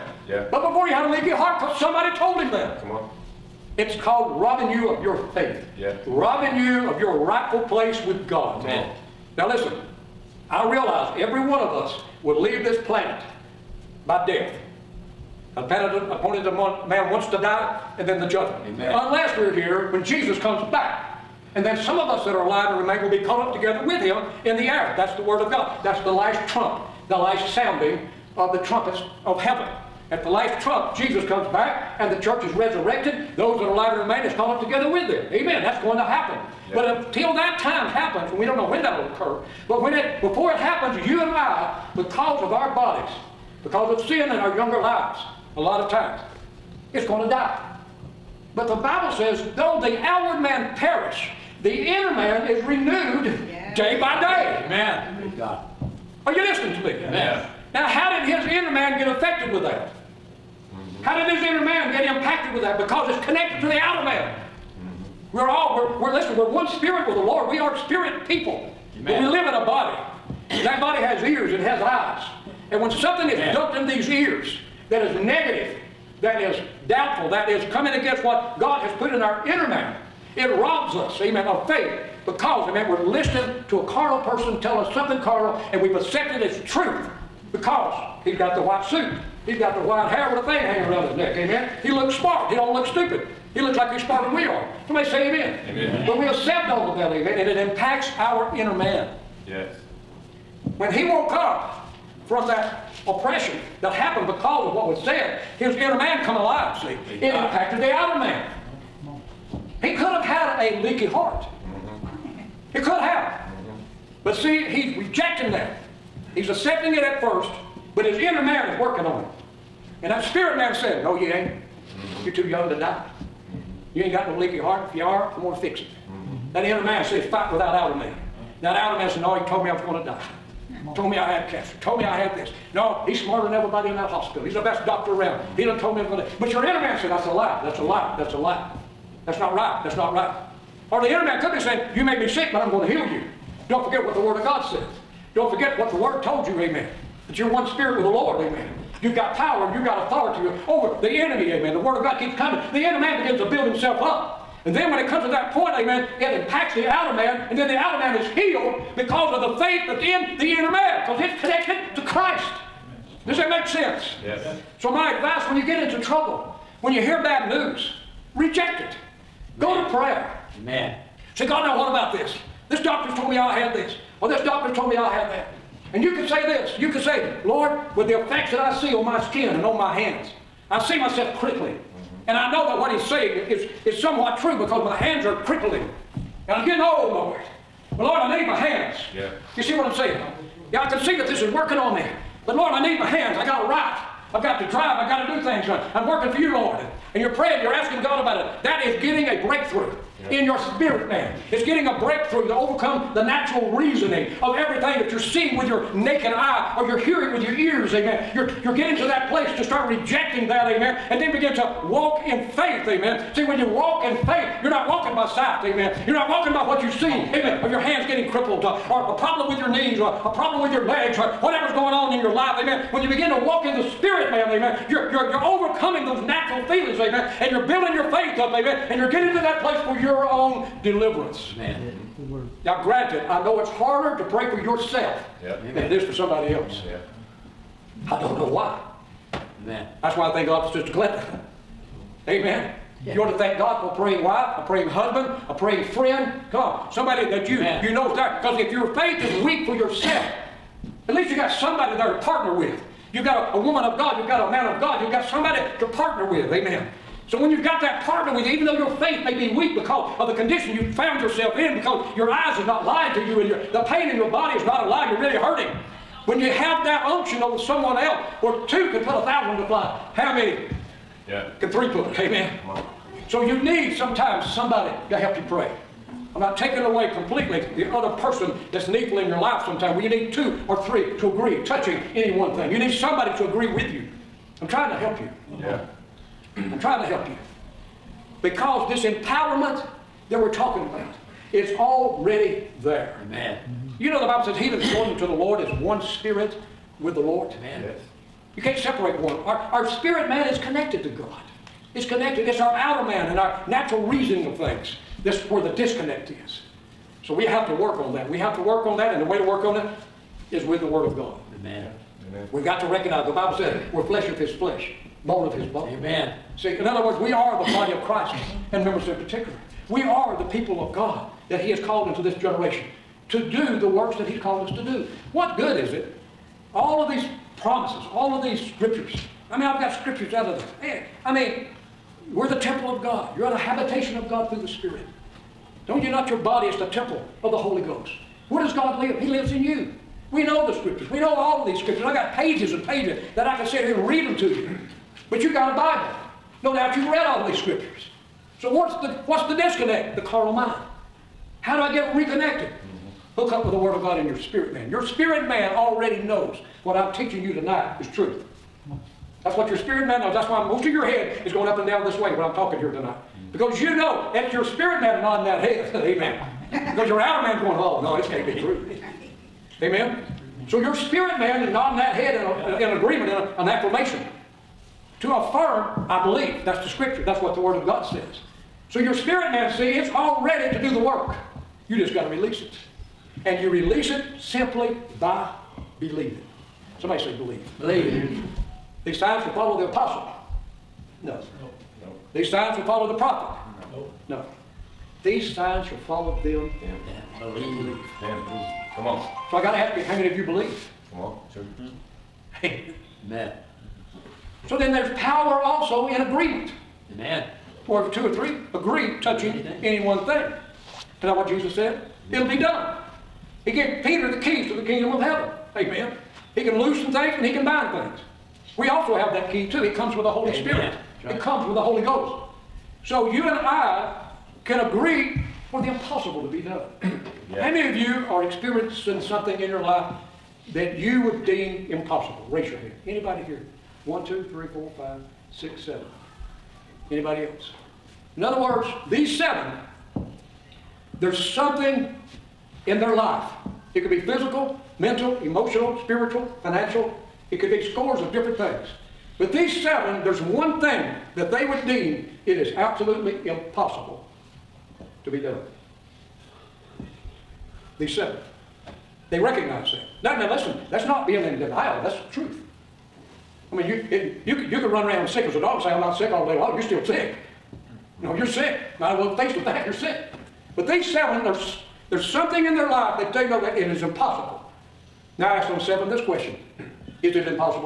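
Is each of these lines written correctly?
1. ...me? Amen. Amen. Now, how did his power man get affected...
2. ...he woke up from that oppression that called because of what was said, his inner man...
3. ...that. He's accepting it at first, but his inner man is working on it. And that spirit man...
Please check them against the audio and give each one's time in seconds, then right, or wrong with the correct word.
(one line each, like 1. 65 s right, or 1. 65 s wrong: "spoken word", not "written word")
1. 56 s wrong: "inner", not "power"
2. 100 s wrong: "happened", not "called"
3. 115 s right.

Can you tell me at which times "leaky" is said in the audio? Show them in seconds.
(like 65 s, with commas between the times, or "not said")
1 s, 110 s, 124 s.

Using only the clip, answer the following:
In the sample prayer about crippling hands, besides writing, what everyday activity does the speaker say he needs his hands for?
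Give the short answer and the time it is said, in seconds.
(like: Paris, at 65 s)
drive, at 194 s.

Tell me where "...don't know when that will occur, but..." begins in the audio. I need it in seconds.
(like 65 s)
38 s.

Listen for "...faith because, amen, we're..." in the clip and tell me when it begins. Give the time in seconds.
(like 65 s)
81 s.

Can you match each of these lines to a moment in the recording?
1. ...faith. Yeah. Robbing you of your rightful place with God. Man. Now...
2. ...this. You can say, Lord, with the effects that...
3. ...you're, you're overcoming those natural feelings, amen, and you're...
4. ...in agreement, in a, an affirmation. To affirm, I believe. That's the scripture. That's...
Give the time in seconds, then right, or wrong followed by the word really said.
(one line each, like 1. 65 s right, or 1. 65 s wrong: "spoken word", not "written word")
1. 5 s right
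2. 176 s right
3. 225 s right
4. 372 s right.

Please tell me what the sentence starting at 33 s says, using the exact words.
Those that are alive and remain is caught up together with them.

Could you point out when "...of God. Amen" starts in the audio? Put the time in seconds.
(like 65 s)
311 s.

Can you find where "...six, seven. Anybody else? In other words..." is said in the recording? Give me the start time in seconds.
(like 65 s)
435 s.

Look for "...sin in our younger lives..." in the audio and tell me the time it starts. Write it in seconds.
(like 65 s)
44 s.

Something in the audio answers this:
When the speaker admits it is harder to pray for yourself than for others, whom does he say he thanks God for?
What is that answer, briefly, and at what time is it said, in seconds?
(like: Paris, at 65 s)
Sister Glenda, at 240 s.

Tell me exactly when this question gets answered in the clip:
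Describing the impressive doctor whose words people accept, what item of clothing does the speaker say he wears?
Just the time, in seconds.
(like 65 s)
88 s.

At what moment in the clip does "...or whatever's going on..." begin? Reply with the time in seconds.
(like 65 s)
221 s.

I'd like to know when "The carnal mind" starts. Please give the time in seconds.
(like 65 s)
350 s.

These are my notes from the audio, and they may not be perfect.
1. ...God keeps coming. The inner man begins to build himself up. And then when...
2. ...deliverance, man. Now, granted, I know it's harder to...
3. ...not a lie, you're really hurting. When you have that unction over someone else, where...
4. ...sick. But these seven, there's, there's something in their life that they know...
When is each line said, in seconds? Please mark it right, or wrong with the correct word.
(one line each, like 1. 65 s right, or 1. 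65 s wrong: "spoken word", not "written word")
1. 152 s right
2. 230 s right
3. 264 s right
4. 469 s right.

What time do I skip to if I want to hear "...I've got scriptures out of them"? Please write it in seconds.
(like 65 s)
329 s.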